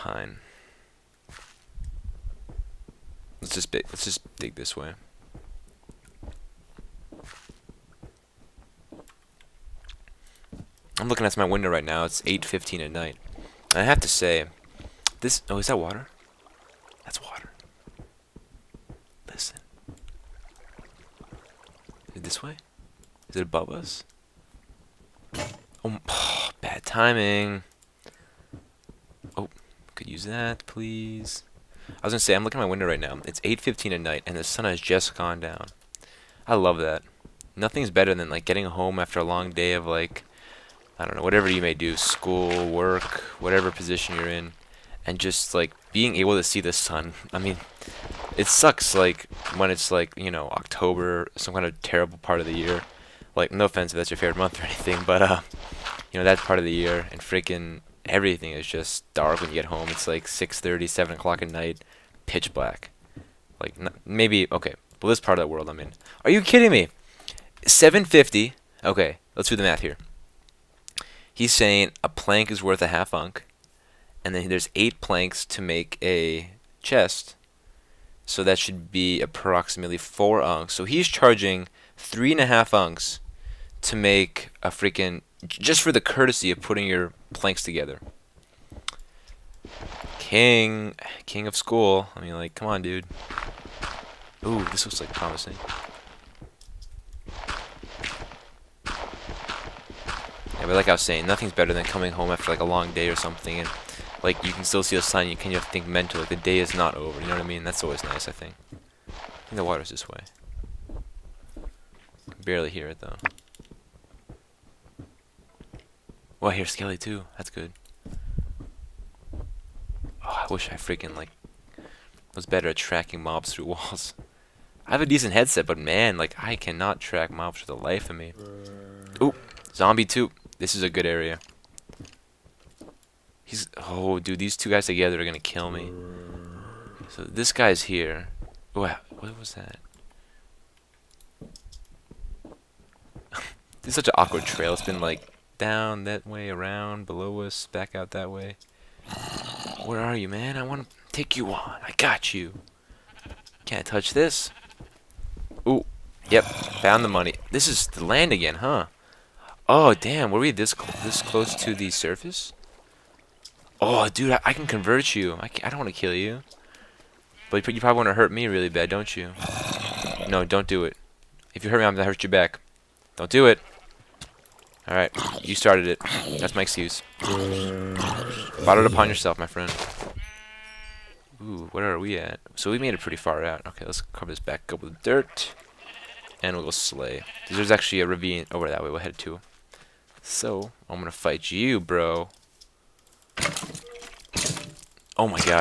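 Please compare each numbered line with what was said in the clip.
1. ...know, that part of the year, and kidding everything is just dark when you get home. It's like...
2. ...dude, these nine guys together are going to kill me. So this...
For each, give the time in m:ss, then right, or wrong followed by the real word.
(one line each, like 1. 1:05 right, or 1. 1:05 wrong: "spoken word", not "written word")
1. 0:56 wrong: "freaking", not "kidding"
2. 2:14 wrong: "two", not "nine".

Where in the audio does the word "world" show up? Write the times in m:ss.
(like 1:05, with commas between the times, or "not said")
1:05.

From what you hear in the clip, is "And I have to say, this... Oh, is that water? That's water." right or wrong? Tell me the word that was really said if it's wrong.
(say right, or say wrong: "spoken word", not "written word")
right.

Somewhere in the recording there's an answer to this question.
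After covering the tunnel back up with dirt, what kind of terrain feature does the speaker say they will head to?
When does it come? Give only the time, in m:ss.
3:08.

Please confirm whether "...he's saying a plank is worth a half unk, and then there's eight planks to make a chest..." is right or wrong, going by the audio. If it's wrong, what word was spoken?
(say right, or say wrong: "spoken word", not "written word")
right.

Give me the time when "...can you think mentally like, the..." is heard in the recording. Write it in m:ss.
1:45.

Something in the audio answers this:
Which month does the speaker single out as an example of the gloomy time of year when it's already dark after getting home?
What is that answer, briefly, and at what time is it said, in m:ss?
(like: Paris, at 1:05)
October, at 0:50.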